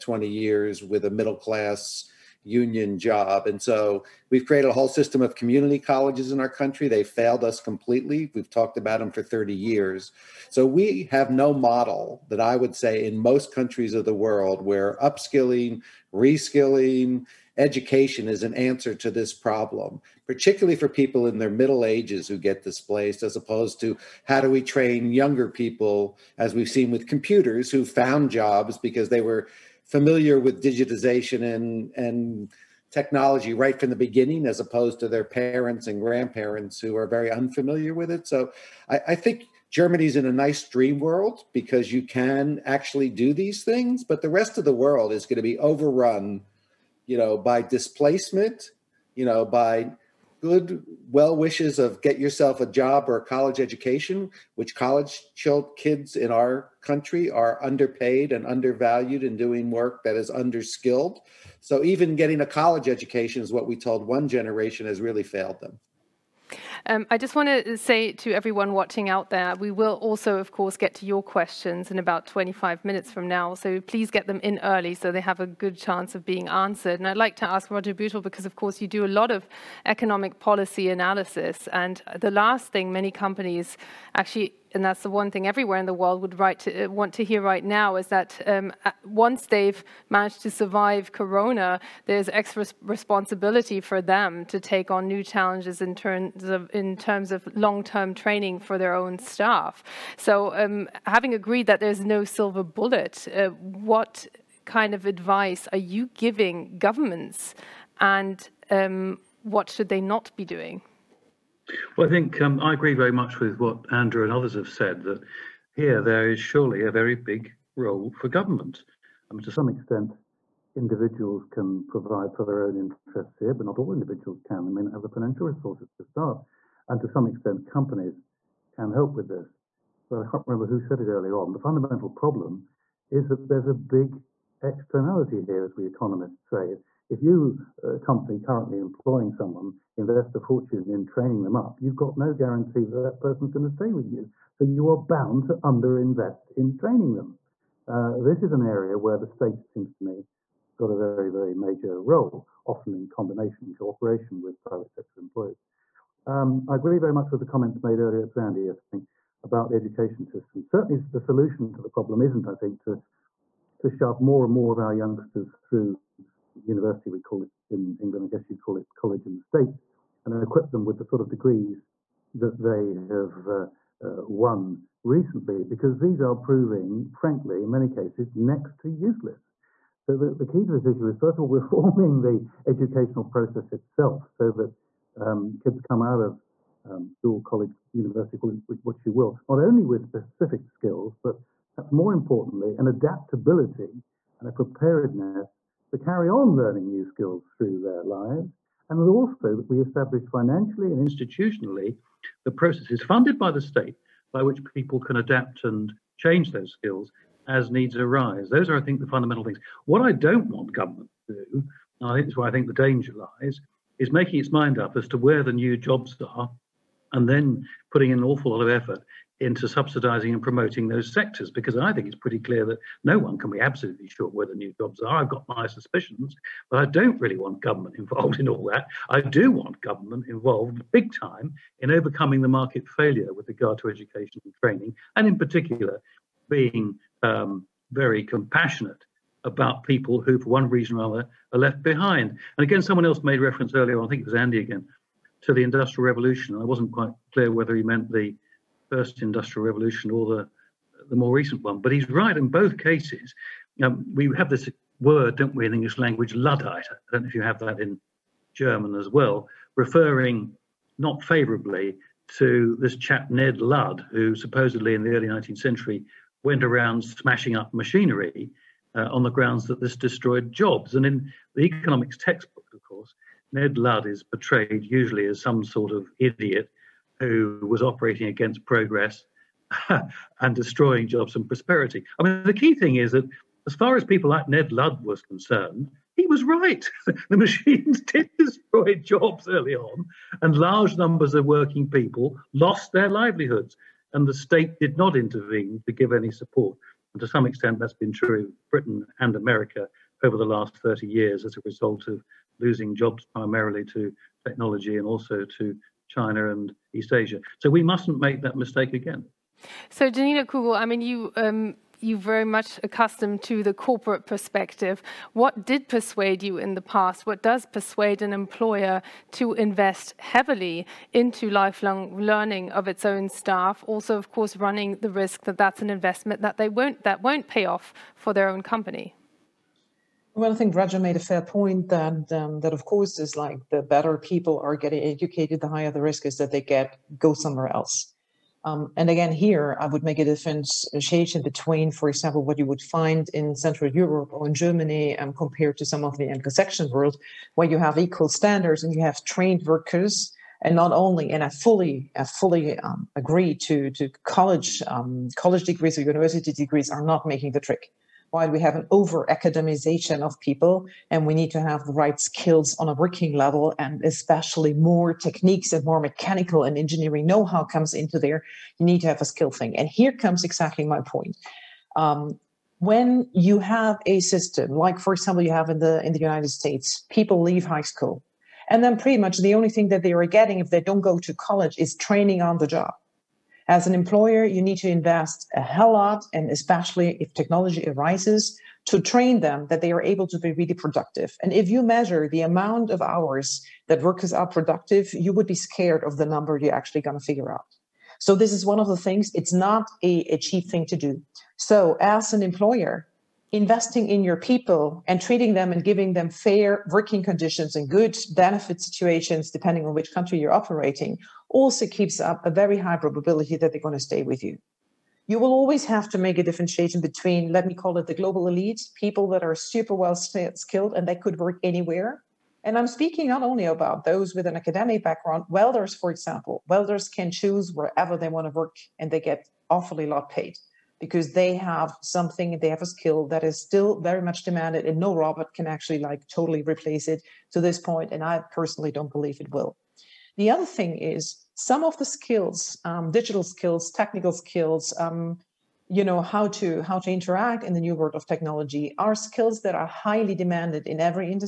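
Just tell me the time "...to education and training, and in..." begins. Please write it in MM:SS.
03:53.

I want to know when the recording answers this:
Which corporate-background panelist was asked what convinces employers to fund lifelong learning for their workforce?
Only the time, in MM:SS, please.
05:10.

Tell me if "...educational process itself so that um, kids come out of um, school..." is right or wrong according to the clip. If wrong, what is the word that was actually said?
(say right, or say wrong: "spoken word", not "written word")
right.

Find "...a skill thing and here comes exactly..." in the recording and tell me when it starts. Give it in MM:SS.
06:09.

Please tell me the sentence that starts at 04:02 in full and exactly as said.
And again, someone else made reference earlier, I think it was Andy again, to the Industrial Revolution.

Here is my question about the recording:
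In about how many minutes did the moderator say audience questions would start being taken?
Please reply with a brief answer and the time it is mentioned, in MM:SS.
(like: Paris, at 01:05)
25, at 01:12.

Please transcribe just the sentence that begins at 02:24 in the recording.
So you are bound to underinvest in training them.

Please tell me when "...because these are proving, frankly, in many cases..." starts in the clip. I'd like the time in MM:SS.
02:55.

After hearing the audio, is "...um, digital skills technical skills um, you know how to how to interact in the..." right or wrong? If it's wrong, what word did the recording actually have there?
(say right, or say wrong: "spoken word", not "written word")
right.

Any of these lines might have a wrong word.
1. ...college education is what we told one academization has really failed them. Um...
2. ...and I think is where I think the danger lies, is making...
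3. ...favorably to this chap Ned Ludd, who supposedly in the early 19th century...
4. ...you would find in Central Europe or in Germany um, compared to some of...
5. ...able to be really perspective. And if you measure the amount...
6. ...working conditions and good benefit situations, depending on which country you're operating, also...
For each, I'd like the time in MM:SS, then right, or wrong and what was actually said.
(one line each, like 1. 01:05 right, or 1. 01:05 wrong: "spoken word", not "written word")
1. 01:02 wrong: "generation", not "academization"
2. 03:32 right
3. 04:21 right
4. 05:42 right
5. 06:30 wrong: "productive", not "perspective"
6. 06:46 right.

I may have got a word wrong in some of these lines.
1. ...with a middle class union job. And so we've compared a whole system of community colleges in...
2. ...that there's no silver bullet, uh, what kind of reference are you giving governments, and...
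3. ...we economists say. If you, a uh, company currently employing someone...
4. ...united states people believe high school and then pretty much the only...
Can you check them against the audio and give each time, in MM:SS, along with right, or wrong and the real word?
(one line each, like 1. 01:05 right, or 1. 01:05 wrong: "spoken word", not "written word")
1. 00:00 wrong: "created", not "compared"
2. 01:41 wrong: "advice", not "reference"
3. 02:15 right
4. 06:16 wrong: "leave", not "believe".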